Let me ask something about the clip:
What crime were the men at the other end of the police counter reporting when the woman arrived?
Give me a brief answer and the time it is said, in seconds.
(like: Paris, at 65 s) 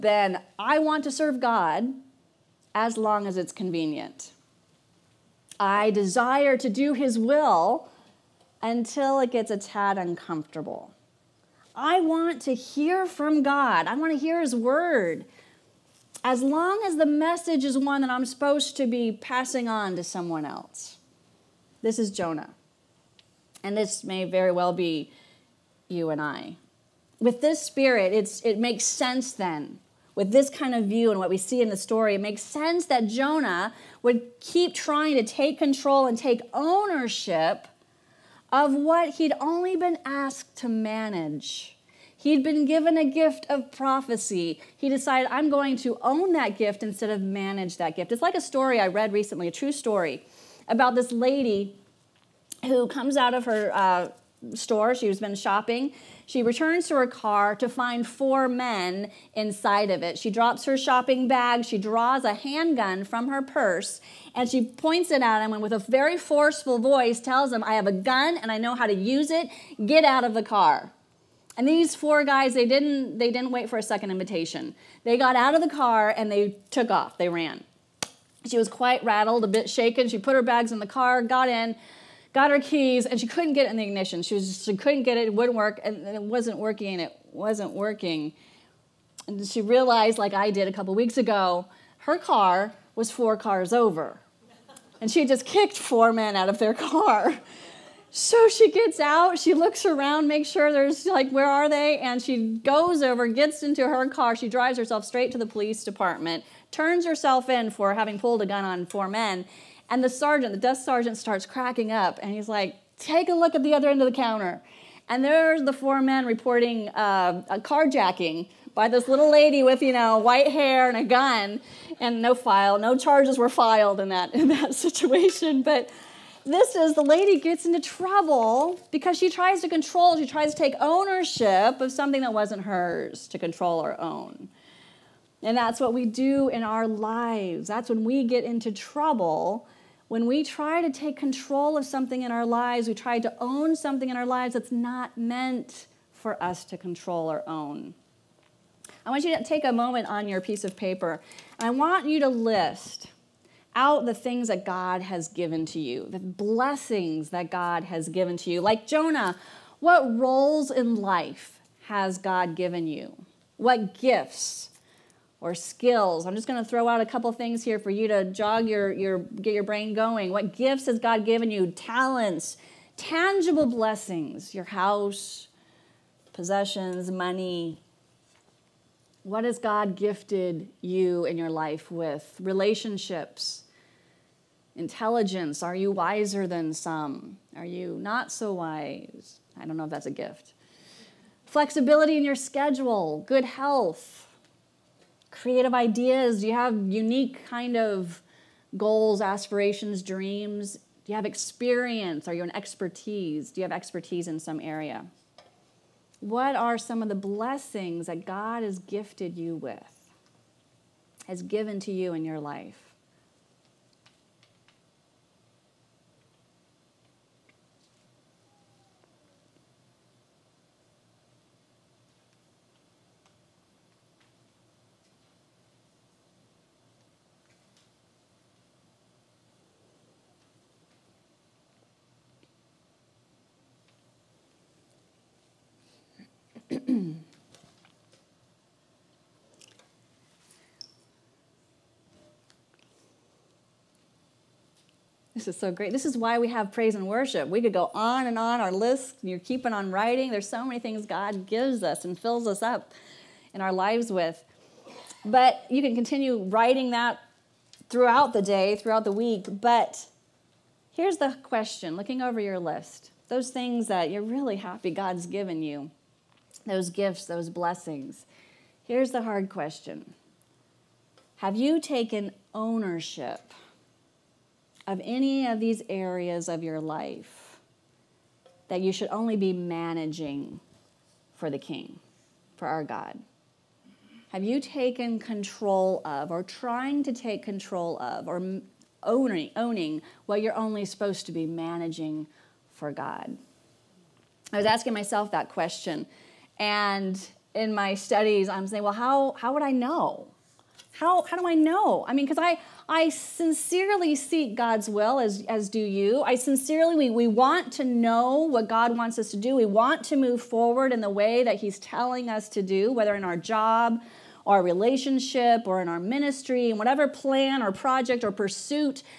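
A carjacking, at 117 s.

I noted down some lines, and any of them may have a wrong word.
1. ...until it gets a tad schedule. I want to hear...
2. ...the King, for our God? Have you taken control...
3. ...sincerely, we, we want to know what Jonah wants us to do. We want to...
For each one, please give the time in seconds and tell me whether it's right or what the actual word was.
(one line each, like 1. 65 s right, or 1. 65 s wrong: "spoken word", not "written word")
1. 8 s wrong: "uncomfortable", not "schedule"
2. 281 s right
3. 306 s wrong: "God", not "Jonah".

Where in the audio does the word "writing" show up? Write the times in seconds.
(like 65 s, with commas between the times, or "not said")
249 s, 256 s.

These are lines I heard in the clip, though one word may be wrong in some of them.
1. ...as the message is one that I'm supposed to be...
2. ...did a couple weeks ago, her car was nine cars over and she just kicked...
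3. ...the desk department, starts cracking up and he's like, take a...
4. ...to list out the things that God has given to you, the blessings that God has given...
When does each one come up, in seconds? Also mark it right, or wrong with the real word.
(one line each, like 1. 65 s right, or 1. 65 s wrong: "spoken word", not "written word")
1. 16 s right
2. 90 s wrong: "four", not "nine"
3. 110 s wrong: "sergeant", not "department"
4. 152 s right.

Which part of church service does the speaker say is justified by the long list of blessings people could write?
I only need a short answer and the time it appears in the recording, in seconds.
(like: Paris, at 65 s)
Praise and worship, at 246 s.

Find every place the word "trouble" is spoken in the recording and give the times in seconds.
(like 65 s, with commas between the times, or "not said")
127 s, 138 s.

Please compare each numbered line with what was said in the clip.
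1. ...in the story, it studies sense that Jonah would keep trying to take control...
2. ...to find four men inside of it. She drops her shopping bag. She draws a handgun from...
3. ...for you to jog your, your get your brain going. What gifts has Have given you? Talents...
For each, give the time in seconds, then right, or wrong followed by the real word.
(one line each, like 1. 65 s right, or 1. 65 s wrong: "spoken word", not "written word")
1. 31 s wrong: "makes", not "studies"
2. 57 s right
3. 167 s wrong: "God", not "Have".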